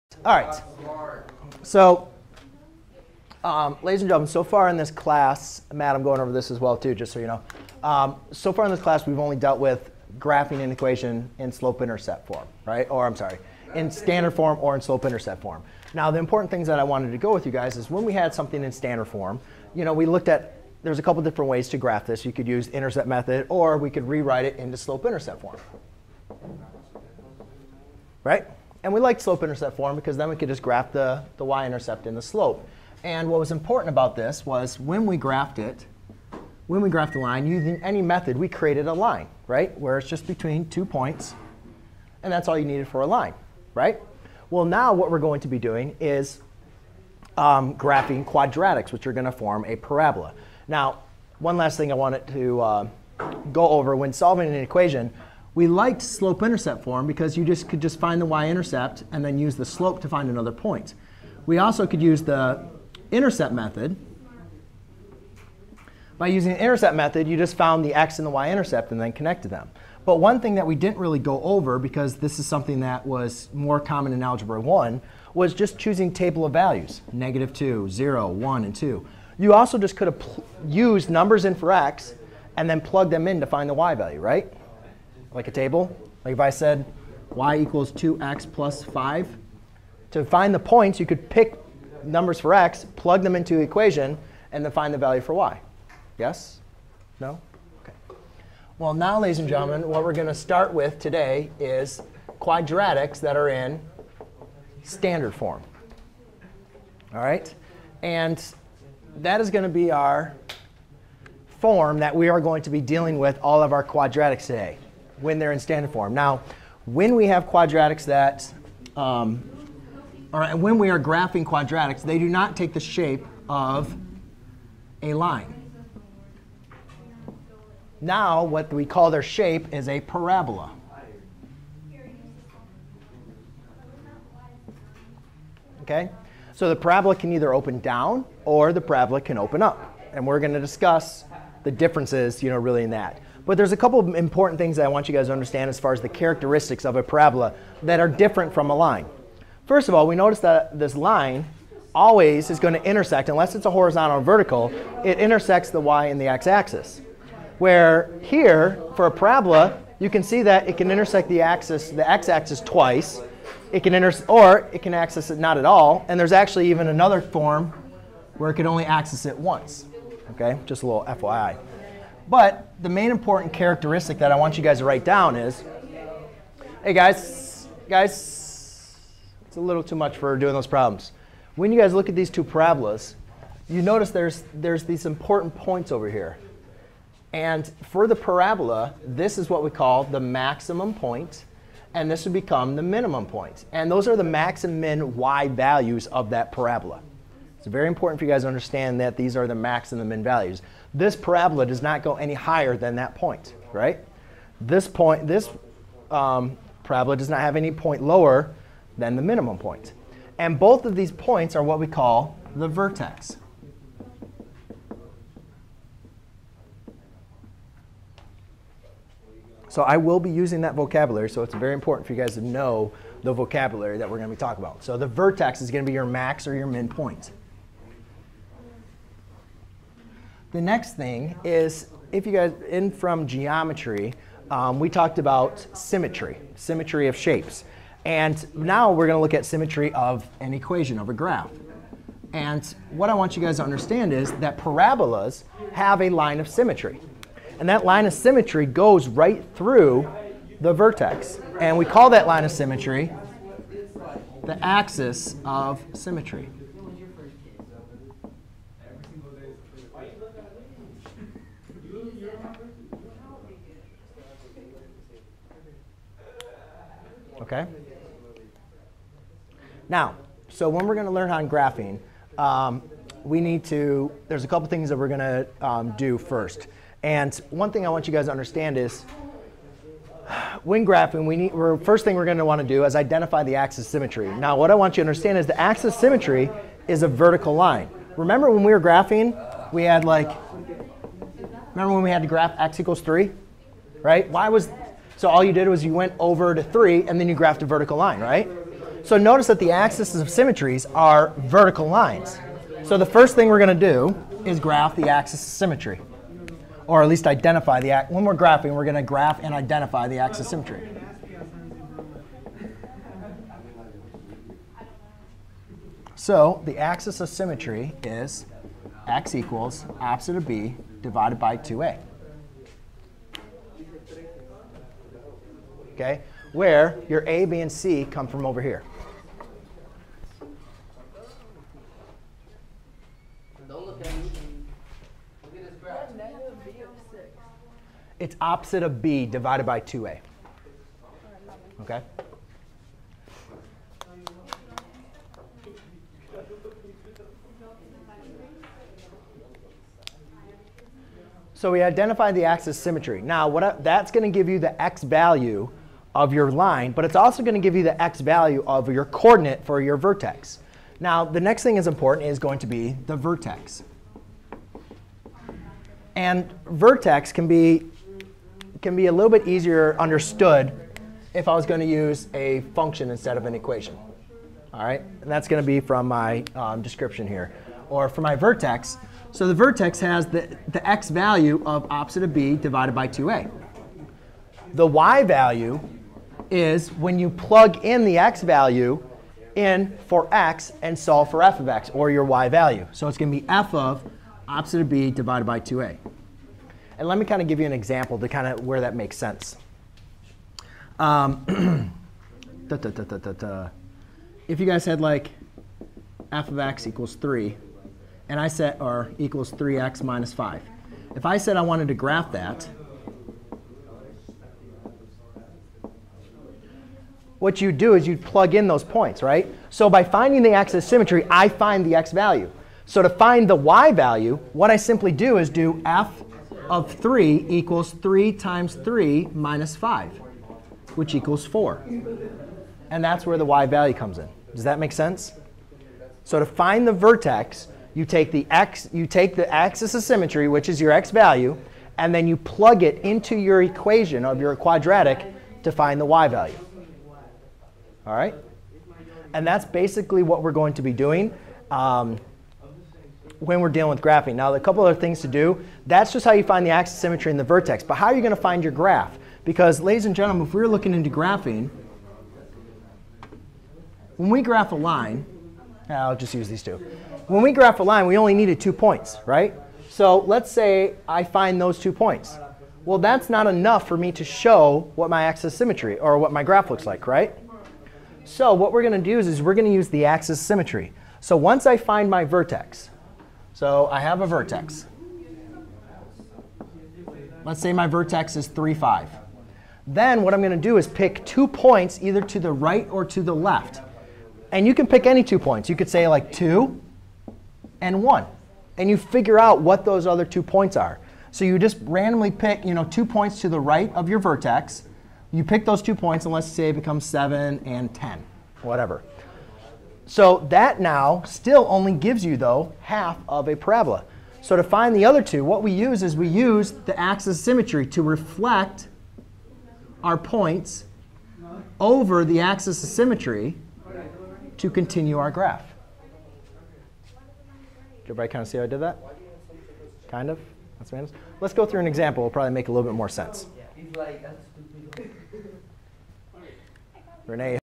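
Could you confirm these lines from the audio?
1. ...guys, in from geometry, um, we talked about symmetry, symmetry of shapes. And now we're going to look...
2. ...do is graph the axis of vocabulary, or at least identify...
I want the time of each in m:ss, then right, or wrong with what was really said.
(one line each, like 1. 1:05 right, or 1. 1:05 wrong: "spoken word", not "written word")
1. 3:52 right
2. 5:03 wrong: "symmetry", not "vocabulary".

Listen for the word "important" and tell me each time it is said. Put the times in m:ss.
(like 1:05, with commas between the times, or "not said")
0:16, 0:33, 2:24, 2:53, 3:05, 3:17, 3:41, 6:01.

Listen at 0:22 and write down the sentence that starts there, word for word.
You could use intercept method, or we could rewrite it into slope-intercept form, right?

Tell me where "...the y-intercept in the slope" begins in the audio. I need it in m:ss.
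0:31.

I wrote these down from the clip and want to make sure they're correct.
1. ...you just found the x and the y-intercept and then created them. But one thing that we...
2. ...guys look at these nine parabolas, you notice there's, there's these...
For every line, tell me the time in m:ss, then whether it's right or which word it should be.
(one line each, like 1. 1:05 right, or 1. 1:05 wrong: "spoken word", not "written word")
1. 1:07 wrong: "connected", not "created"
2. 3:01 wrong: "two", not "nine".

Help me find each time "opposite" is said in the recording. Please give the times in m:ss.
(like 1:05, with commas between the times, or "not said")
5:19, 5:38, 6:21, 6:34.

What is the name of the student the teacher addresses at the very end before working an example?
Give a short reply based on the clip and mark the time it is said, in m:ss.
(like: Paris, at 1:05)
Renee, at 8:57.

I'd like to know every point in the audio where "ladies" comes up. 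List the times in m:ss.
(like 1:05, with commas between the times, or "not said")
0:03, 1:39, 7:39.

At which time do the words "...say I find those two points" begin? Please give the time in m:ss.
7:50.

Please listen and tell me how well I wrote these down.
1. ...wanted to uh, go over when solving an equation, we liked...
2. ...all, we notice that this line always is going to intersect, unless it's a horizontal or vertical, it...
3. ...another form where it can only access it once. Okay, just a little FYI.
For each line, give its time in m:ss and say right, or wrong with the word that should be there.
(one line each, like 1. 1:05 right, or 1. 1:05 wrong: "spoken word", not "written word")
1. 0:51 right
2. 2:29 right
3. 2:46 right.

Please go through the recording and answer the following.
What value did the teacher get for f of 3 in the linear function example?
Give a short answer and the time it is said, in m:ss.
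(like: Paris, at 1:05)
4, at 7:11.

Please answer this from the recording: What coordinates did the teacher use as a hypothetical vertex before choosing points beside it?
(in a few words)
(3, 5).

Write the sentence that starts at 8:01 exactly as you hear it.
So once I find my vertex, so I have a vertex.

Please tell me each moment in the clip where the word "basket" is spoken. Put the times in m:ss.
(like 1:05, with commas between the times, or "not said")
not said.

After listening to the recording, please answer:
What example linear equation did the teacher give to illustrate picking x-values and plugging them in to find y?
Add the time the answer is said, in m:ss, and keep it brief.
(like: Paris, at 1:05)
y = 2x + 5, at 1:27.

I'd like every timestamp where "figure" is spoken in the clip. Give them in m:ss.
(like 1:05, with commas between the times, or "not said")
8:18.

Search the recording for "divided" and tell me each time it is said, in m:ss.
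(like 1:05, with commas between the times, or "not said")
5:21, 5:39, 6:22, 6:35.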